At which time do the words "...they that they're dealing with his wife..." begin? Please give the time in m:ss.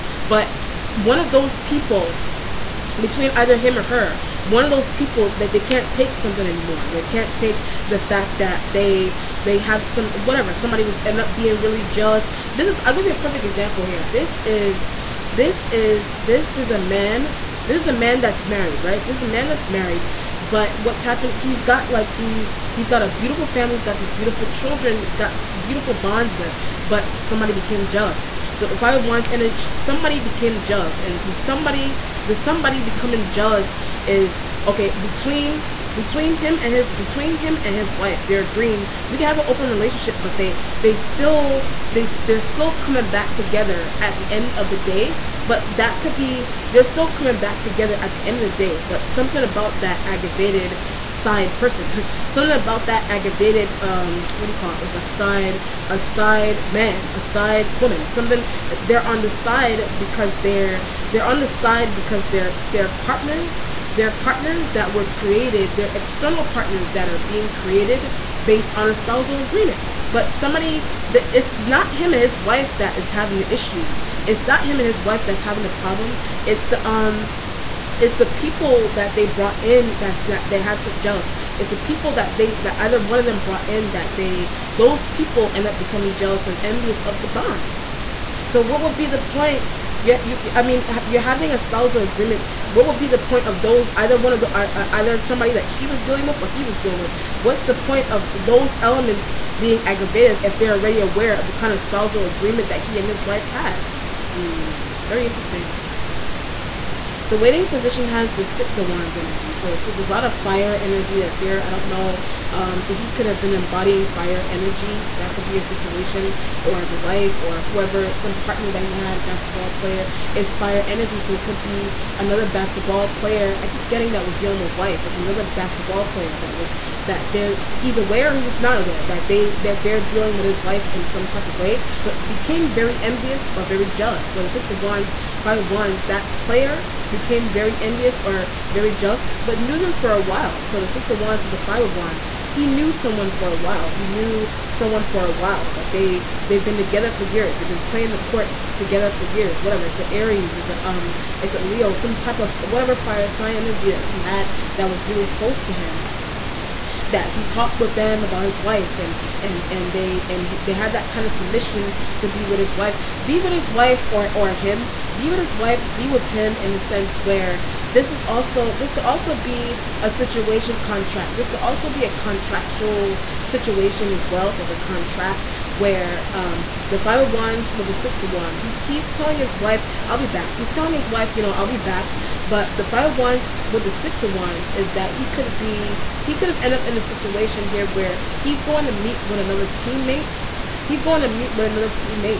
2:09.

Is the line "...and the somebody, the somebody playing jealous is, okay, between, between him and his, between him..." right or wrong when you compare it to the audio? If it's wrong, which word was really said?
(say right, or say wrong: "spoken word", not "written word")
wrong: "becoming", not "playing".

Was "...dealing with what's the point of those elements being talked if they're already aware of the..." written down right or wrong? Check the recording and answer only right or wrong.
wrong.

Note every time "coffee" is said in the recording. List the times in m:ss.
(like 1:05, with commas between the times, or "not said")
not said.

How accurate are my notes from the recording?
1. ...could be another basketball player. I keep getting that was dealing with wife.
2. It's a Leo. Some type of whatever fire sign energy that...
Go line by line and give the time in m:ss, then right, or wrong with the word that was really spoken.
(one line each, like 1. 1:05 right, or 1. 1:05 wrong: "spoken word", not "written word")
1. 2:01 right
2. 2:31 right.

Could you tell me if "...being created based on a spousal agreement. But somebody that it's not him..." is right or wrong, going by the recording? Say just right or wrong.
right.